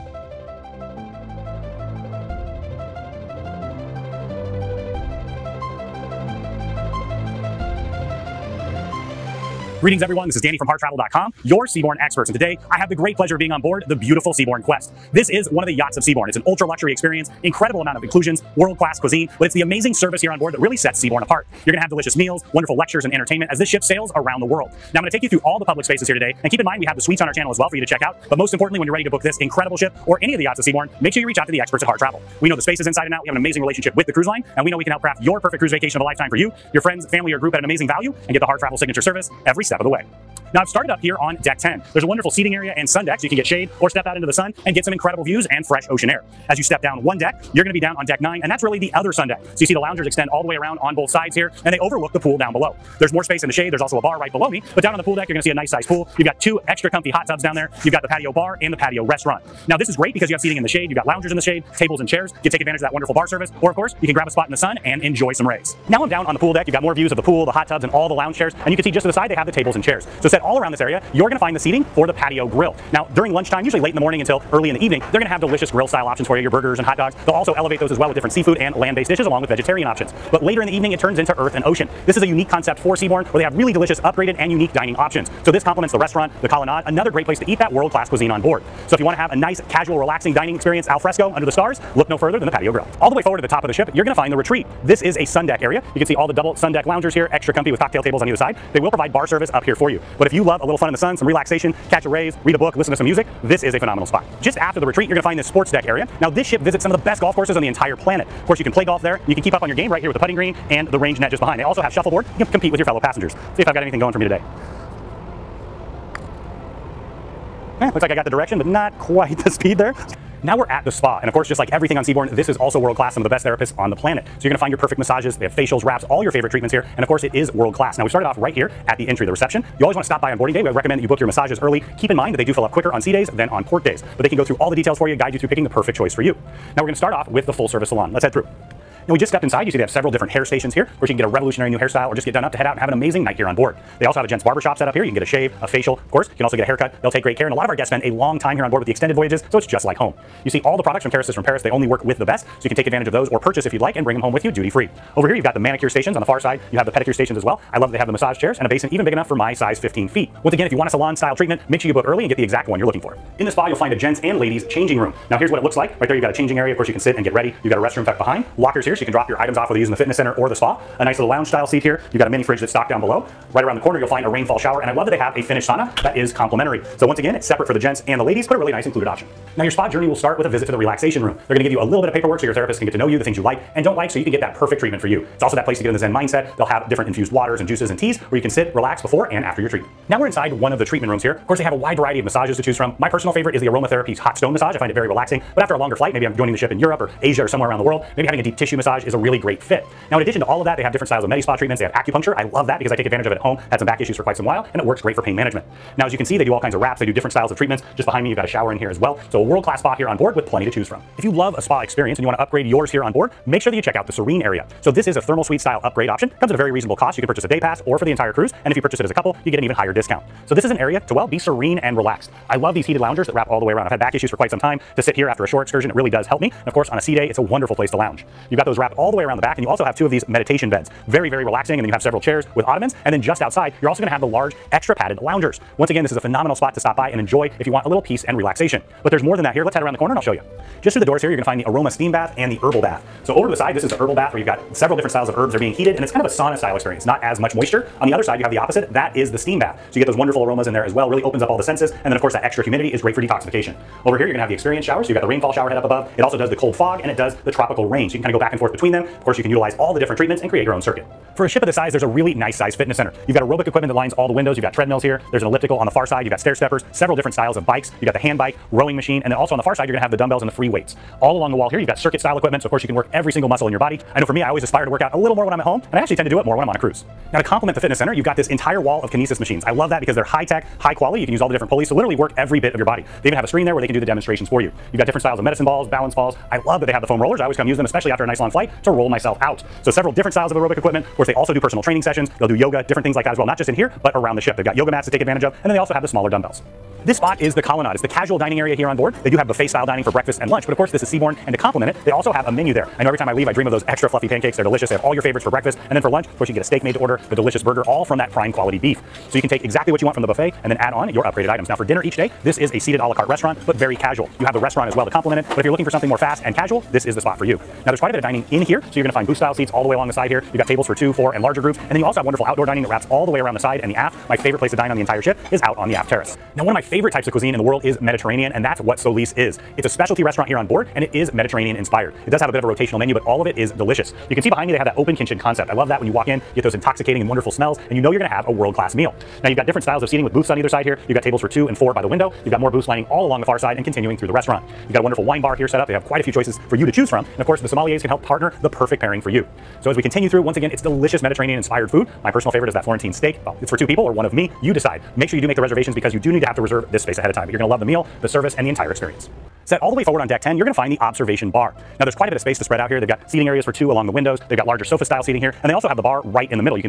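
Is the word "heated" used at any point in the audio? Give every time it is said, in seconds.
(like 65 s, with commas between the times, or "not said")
222 s, 245 s.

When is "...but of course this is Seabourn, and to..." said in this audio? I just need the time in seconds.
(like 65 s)
300 s.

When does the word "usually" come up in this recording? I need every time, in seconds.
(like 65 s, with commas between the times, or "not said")
73 s.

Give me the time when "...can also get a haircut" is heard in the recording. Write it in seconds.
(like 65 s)
146 s.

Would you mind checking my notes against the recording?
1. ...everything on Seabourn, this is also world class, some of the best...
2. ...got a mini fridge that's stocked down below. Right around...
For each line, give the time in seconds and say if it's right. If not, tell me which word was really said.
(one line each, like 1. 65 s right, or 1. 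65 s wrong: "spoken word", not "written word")
1. 121 s right
2. 172 s right.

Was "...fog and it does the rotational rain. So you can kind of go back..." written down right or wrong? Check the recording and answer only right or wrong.
wrong.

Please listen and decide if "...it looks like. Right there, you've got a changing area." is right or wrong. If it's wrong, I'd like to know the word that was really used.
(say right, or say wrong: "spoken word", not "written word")
right.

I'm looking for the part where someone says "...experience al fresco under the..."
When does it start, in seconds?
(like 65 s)
90 s.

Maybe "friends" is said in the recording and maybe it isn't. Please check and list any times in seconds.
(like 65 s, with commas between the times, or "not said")
36 s.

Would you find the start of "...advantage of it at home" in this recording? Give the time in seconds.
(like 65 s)
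203 s.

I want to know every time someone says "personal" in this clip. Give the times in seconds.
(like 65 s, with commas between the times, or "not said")
193 s, 291 s, 352 s.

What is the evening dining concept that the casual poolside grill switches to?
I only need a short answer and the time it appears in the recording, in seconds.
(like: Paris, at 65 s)
Earth and Ocean, at 81 s.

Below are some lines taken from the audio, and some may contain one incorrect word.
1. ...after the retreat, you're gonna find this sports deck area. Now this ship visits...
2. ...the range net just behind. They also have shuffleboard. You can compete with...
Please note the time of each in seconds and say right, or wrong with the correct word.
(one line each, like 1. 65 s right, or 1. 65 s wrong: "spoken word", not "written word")
1. 104 s right
2. 110 s right.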